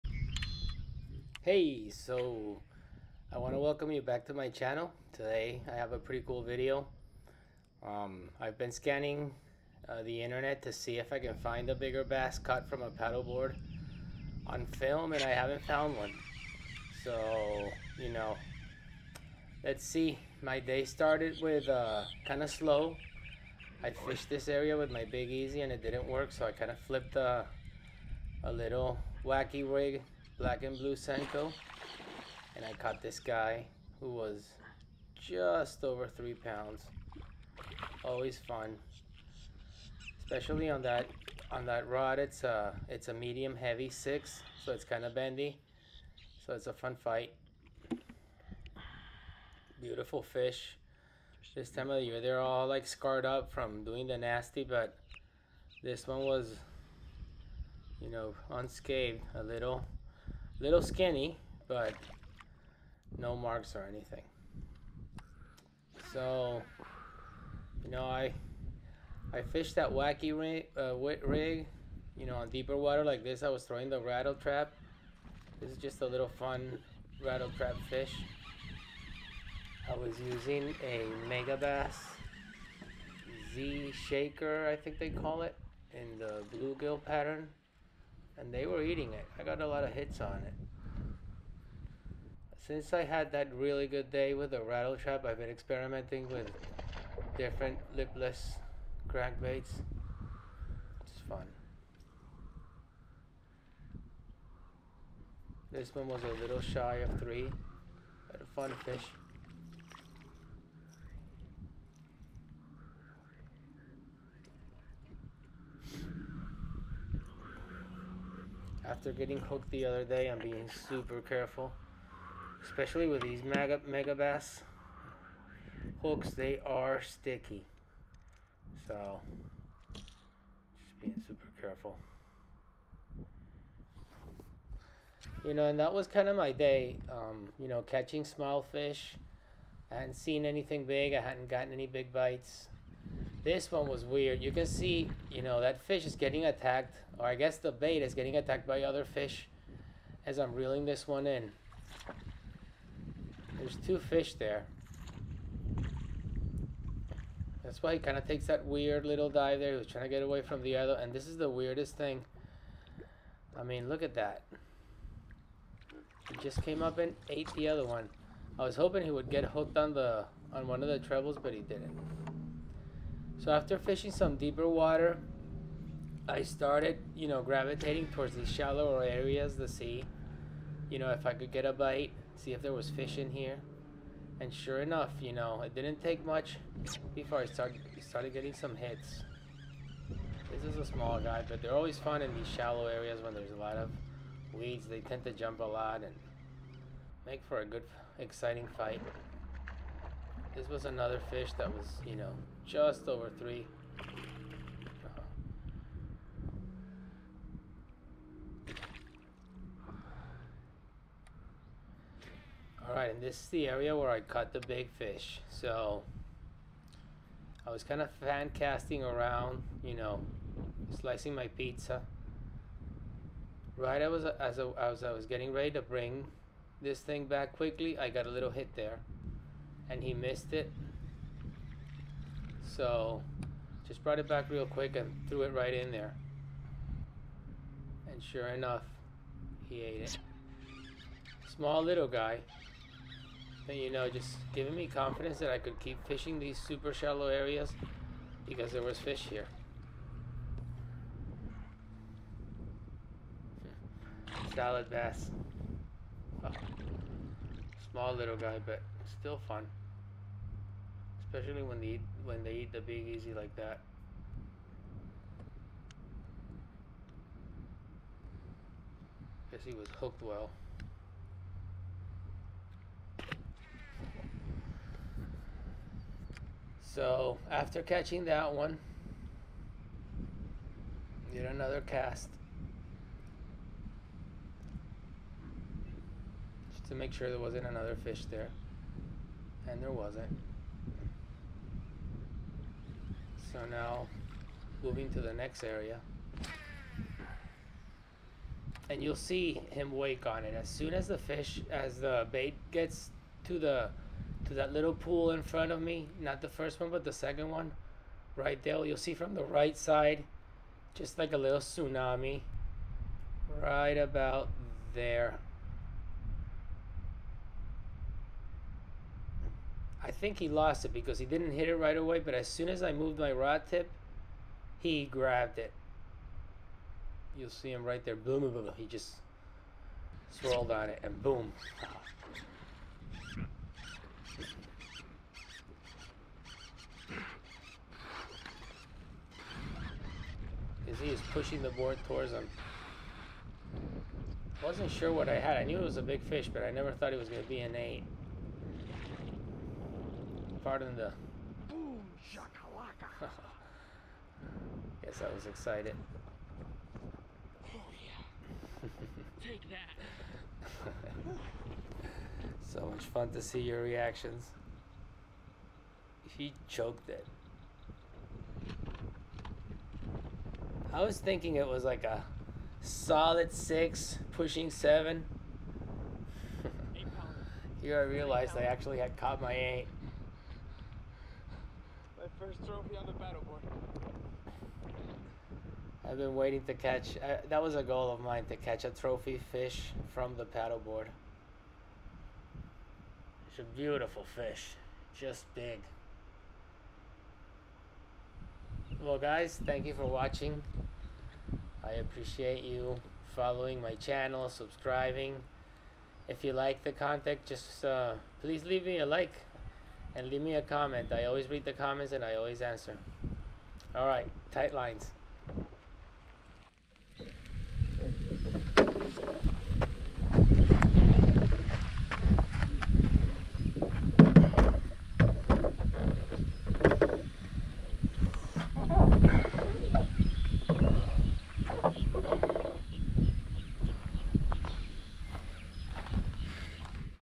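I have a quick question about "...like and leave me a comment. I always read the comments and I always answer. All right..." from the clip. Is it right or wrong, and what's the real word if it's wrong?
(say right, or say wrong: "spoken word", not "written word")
right.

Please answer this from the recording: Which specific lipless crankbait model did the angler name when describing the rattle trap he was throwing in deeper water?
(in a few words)
Megabass Z Shaker.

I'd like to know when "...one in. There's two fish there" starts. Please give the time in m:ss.
2:31.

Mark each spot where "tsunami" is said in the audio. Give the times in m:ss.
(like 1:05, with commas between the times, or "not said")
5:11.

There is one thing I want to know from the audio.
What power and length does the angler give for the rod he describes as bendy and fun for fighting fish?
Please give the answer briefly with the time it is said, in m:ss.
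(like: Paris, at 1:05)
medium heavy six, at 0:43.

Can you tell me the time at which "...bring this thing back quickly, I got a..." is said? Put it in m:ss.
3:45.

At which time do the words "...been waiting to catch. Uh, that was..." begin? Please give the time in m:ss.
6:26.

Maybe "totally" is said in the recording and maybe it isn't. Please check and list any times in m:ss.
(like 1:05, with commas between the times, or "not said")
not said.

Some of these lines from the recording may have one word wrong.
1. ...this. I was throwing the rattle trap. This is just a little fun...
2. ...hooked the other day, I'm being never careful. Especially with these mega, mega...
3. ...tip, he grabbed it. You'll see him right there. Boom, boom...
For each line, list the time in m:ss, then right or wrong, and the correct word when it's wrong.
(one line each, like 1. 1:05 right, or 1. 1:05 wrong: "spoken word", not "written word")
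1. 1:13 right
2. 1:59 wrong: "super", not "never"
3. 5:23 right.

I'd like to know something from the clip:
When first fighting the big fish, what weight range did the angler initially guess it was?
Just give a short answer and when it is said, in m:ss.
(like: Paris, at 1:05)
six, pushing seven, at 6:12.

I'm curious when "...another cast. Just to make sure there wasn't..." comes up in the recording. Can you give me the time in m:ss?
4:41.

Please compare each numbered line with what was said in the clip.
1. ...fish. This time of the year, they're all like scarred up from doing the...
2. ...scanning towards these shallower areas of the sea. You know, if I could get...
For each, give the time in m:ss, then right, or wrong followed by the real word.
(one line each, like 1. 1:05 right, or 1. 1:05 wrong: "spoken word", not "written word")
1. 0:50 right
2. 2:57 wrong: "gravitating", not "scanning".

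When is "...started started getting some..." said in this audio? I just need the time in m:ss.
3:07.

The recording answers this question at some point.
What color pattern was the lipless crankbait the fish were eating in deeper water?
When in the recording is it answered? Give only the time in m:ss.
1:26.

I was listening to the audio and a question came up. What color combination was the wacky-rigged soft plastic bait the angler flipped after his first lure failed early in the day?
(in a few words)
black and blue.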